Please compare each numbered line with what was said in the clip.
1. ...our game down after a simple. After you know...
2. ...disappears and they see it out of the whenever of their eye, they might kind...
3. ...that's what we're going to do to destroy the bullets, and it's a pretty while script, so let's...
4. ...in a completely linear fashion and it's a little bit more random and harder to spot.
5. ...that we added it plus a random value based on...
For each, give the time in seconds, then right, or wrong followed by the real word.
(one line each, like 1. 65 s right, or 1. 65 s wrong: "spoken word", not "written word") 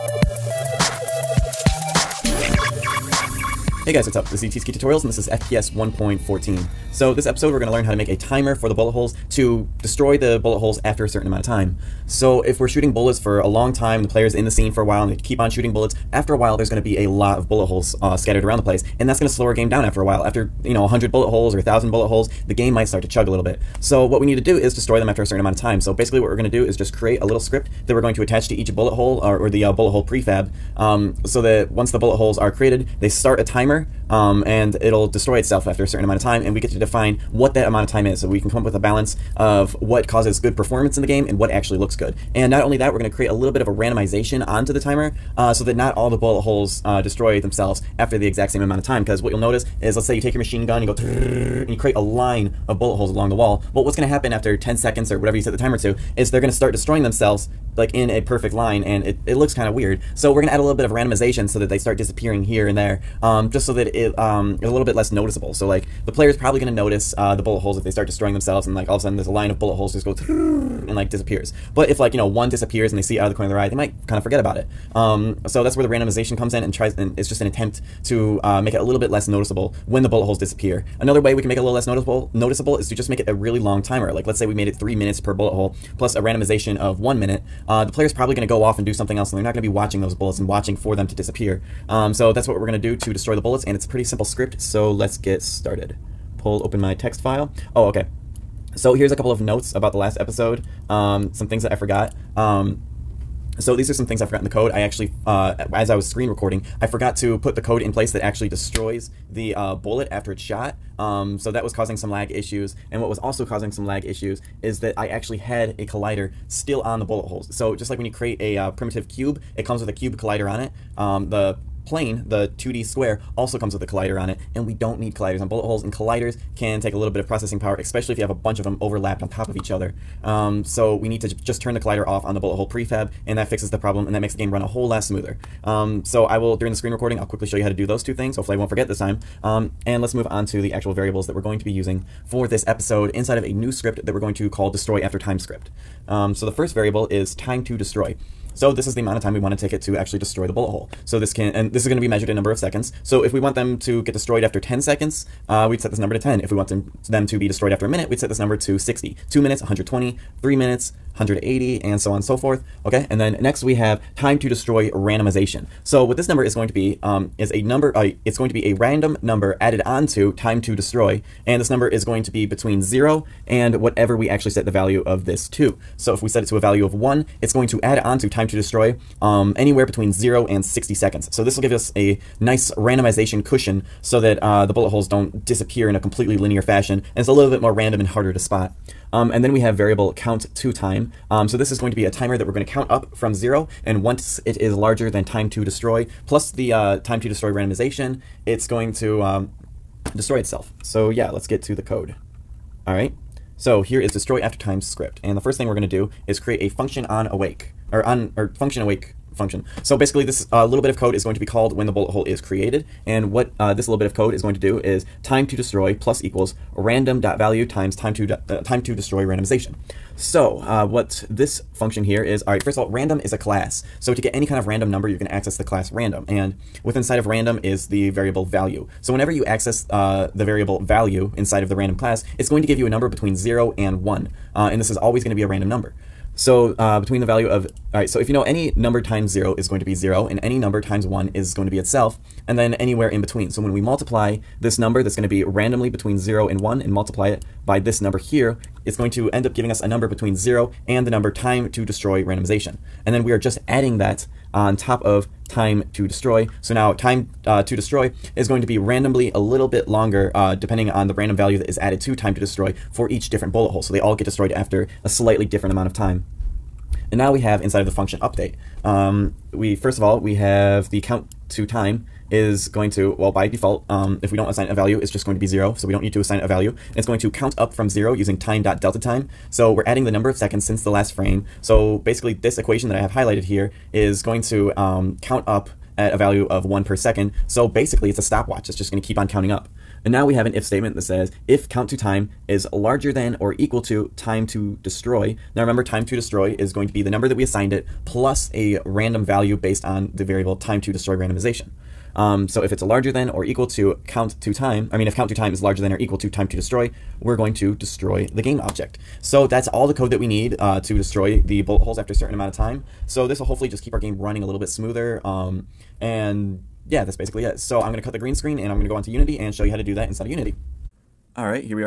1. 19 s wrong: "while", not "simple"
2. 72 s wrong: "corner", not "whenever"
3. 92 s wrong: "simple", not "while"
4. 185 s right
5. 297 s wrong: "assigned", not "added".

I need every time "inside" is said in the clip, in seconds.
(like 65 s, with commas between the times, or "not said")
143 s, 226 s, 231 s, 267 s, 320 s.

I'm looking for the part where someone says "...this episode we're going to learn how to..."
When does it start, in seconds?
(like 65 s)
7 s.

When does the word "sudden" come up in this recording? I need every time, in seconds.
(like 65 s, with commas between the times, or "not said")
69 s.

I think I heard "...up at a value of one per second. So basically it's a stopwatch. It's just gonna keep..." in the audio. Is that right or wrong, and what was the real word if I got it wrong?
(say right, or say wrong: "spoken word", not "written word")
right.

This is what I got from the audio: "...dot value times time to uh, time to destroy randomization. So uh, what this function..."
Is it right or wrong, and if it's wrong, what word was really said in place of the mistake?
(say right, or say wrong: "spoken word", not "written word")
right.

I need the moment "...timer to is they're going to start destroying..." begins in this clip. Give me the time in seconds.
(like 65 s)
55 s.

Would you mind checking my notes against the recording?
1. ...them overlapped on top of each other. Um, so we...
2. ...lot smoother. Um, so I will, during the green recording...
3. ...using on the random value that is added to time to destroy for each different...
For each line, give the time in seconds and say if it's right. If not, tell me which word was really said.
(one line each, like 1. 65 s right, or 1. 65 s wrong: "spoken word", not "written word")
1. 128 s right
2. 134 s wrong: "screen", not "green"
3. 260 s wrong: "depending", not "using".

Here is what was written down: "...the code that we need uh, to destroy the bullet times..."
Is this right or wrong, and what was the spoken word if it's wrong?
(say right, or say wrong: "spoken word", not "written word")
wrong: "holes", not "times".